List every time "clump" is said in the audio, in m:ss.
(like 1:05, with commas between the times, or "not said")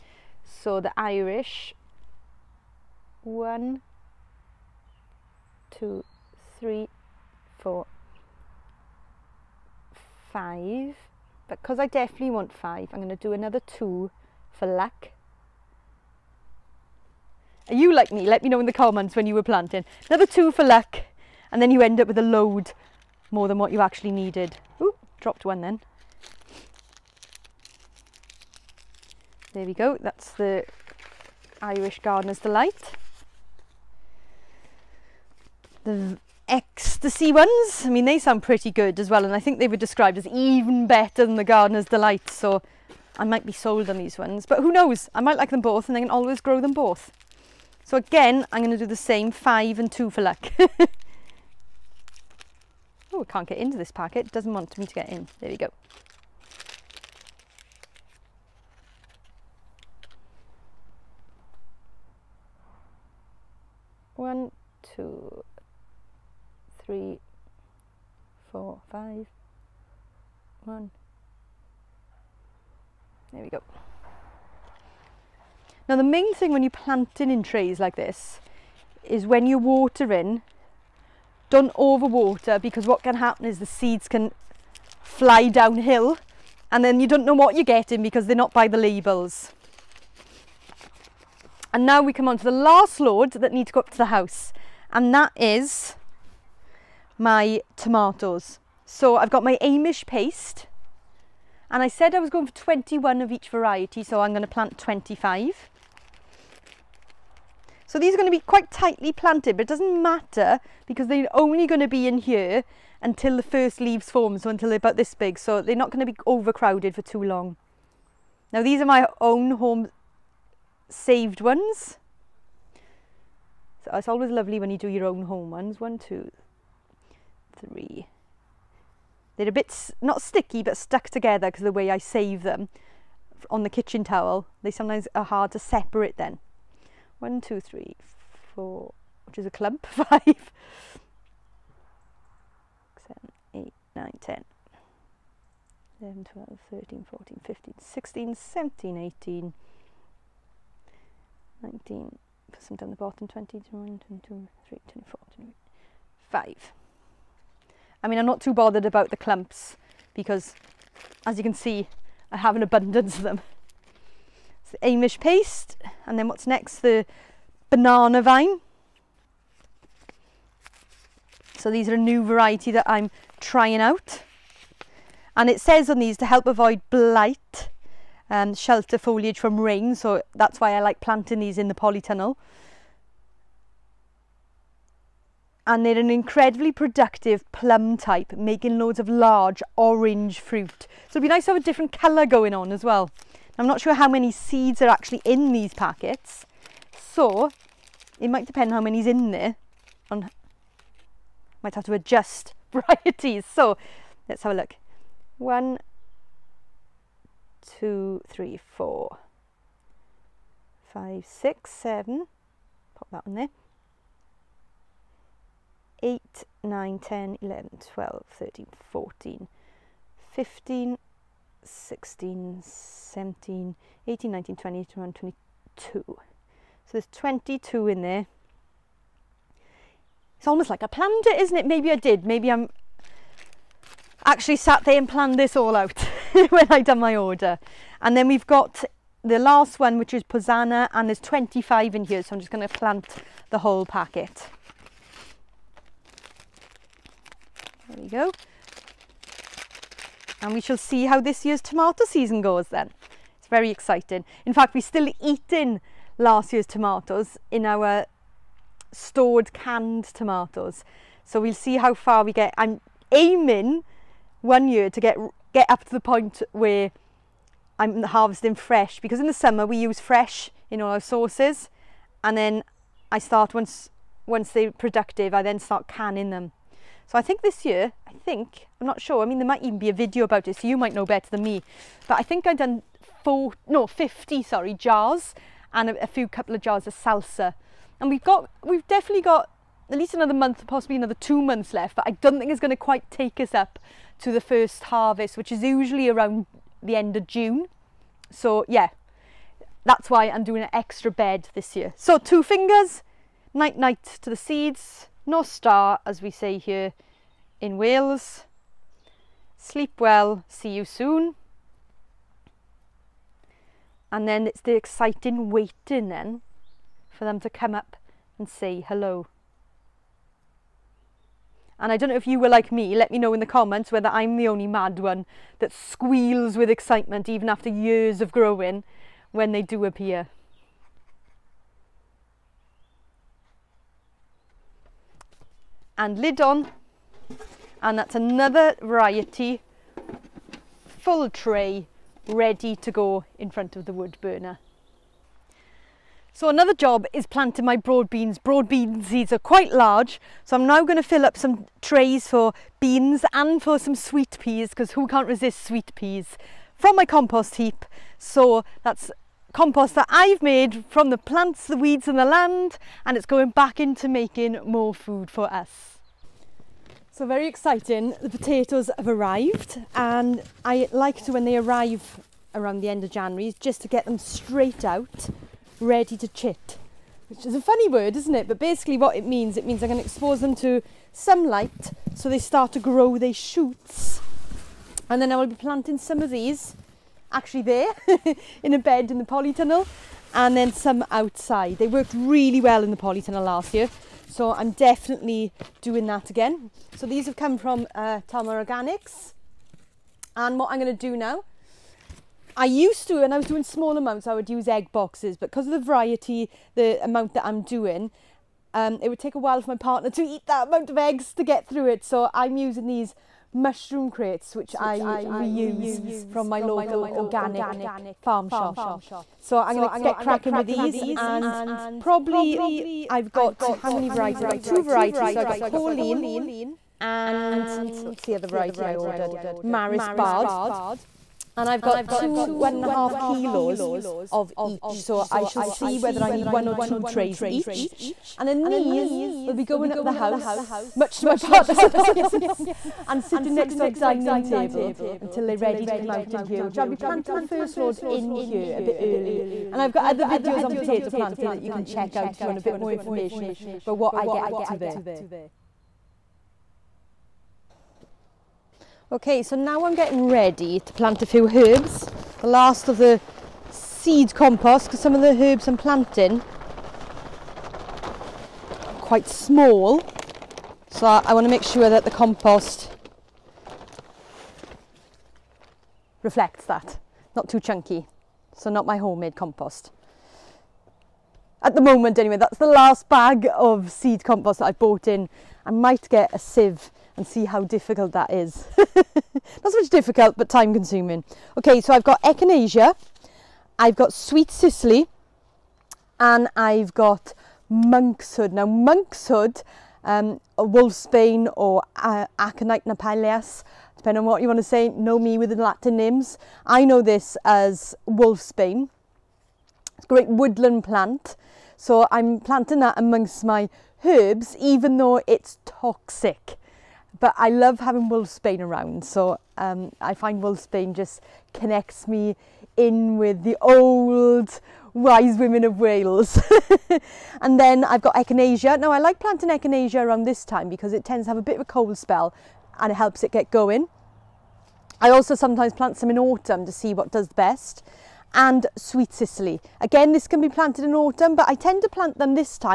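2:19, 2:39.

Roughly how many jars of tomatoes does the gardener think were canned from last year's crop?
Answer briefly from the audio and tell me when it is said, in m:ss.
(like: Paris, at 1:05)
50, at 4:43.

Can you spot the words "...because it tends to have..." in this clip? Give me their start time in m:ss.
8:50.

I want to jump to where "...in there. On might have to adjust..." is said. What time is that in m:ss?
3:19.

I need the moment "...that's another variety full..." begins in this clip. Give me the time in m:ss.
5:37.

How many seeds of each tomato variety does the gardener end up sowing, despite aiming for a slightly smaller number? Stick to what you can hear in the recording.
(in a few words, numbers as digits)
25.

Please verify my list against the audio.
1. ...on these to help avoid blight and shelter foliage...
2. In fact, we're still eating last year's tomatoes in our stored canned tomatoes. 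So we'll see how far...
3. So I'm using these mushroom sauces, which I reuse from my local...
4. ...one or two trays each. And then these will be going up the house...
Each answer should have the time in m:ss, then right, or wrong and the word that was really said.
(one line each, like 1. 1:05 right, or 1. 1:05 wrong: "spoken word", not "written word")
1. 2:55 right
2. 4:14 right
3. 6:52 wrong: "crates", not "sauces"
4. 7:16 right.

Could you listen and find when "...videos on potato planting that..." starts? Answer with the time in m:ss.
7:30.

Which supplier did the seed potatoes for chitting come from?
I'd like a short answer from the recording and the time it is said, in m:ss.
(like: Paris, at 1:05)
Talma Organics, at 6:38.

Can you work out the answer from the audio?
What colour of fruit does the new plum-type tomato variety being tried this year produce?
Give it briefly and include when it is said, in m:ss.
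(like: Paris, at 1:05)
Orange, at 3:09.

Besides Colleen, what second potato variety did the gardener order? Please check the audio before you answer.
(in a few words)
Maris Bard.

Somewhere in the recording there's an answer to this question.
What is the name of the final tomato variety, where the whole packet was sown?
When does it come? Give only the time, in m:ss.
4:00.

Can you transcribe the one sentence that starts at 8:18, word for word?
Now, Monkshood um, a wolfsbane or uh, aconite napalias, depending on what you want to say, know me with the Latin names.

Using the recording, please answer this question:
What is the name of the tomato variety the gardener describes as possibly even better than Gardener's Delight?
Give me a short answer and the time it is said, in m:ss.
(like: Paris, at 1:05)
Ecstasy, at 0:35.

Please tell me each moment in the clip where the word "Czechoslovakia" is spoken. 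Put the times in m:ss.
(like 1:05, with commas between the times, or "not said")
not said.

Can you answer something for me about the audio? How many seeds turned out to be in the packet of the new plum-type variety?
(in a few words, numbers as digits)
22.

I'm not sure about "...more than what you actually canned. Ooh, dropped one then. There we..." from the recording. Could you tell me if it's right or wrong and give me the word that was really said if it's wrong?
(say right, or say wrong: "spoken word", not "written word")
wrong: "needed", not "canned".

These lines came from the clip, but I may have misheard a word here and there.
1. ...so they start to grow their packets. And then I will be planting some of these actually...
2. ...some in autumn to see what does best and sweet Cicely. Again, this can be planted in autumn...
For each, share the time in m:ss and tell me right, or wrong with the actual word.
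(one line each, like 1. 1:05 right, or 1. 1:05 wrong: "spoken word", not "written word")
1. 6:22 wrong: "shoots", not "packets"
2. 8:55 right.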